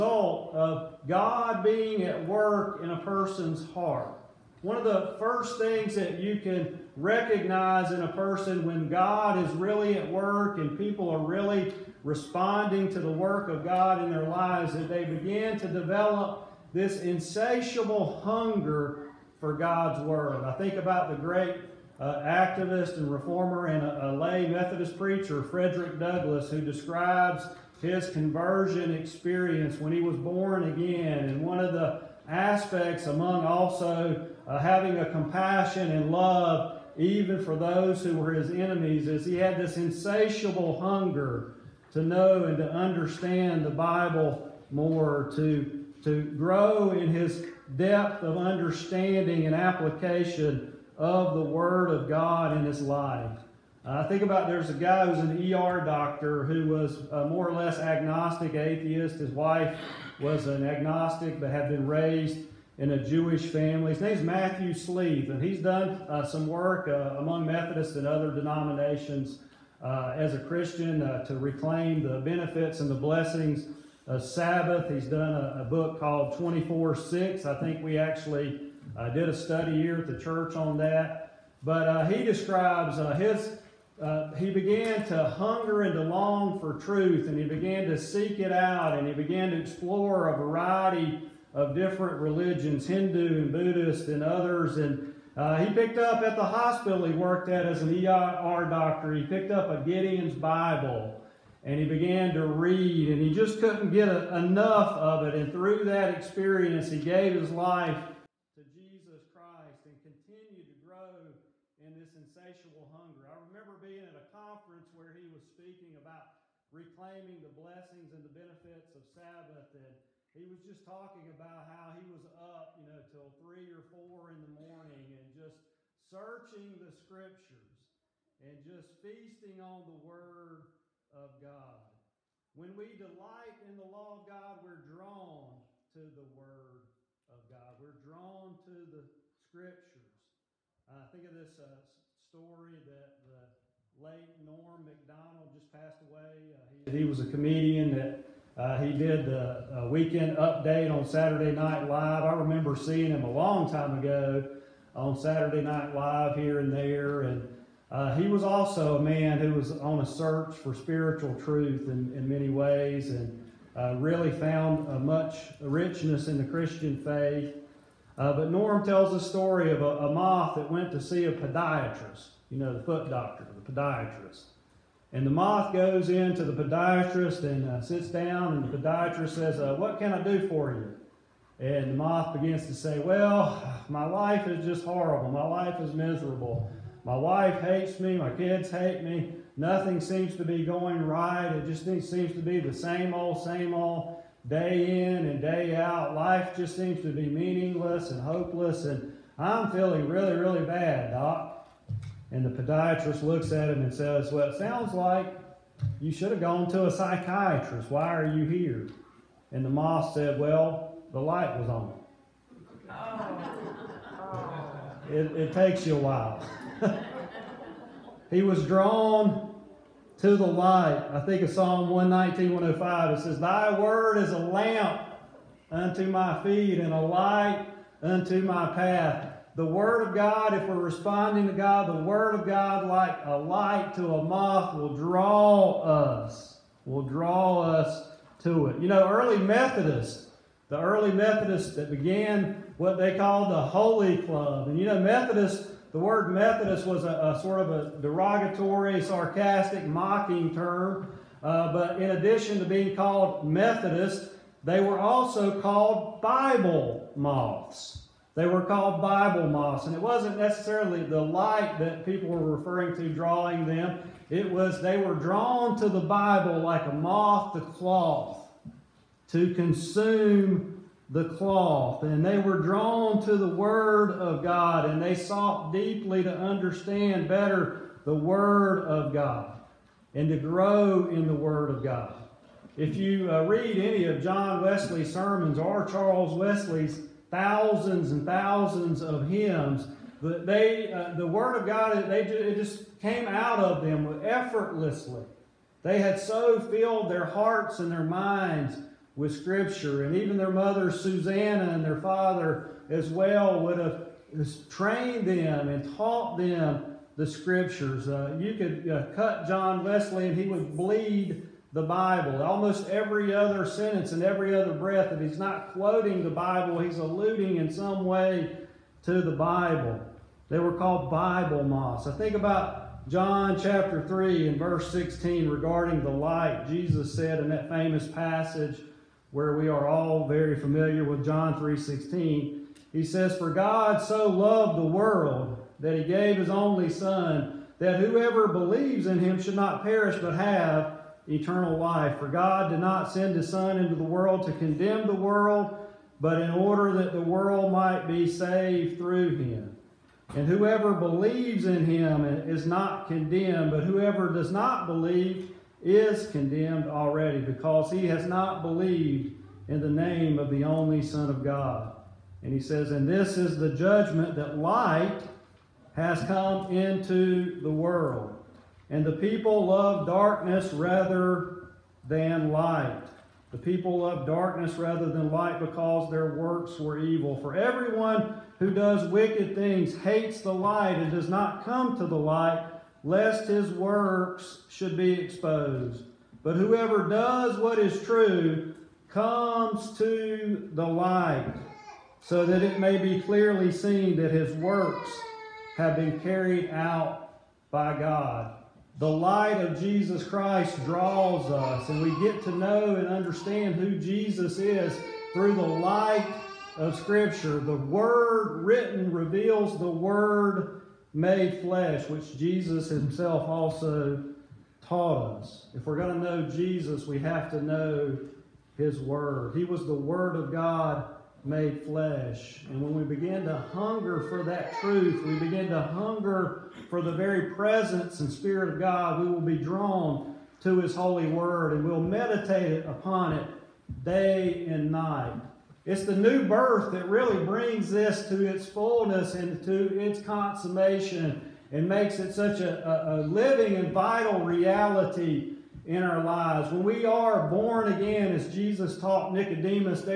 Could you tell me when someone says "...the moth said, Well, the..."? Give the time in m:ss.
3:29.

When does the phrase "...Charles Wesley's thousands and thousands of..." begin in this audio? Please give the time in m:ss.
4:45.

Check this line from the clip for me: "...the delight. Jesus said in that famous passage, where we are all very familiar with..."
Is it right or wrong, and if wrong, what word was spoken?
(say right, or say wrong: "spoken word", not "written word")
wrong: "light", not "delight".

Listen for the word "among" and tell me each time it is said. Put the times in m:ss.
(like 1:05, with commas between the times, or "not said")
0:33, 1:07.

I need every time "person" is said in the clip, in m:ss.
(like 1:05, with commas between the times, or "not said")
0:02, 0:08.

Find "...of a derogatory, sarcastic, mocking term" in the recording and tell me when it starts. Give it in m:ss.
4:07.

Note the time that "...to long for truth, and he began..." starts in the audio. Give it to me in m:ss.
1:25.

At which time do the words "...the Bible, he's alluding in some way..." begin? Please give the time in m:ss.
5:16.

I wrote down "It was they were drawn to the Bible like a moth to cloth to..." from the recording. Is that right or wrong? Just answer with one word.
right.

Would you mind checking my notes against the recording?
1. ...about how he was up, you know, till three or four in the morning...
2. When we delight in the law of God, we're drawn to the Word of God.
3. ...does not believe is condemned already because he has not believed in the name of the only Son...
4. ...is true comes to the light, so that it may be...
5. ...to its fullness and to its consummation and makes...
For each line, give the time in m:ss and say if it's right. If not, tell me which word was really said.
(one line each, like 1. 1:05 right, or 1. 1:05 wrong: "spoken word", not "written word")
1. 2:01 right
2. 2:12 right
3. 5:54 right
4. 6:27 right
5. 7:18 right.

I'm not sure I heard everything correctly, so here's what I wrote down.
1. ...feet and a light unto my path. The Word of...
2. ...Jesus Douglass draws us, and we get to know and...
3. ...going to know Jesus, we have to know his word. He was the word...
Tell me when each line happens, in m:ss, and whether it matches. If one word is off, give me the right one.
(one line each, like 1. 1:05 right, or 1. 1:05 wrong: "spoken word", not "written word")
1. 3:46 right
2. 6:39 wrong: "Christ", not "Douglass"
3. 6:55 right.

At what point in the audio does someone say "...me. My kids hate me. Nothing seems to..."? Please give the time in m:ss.
3:08.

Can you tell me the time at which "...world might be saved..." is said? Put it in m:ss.
5:47.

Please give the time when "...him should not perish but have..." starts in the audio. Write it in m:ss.
5:39.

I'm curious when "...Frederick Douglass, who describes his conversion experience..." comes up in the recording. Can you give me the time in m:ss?
0:25.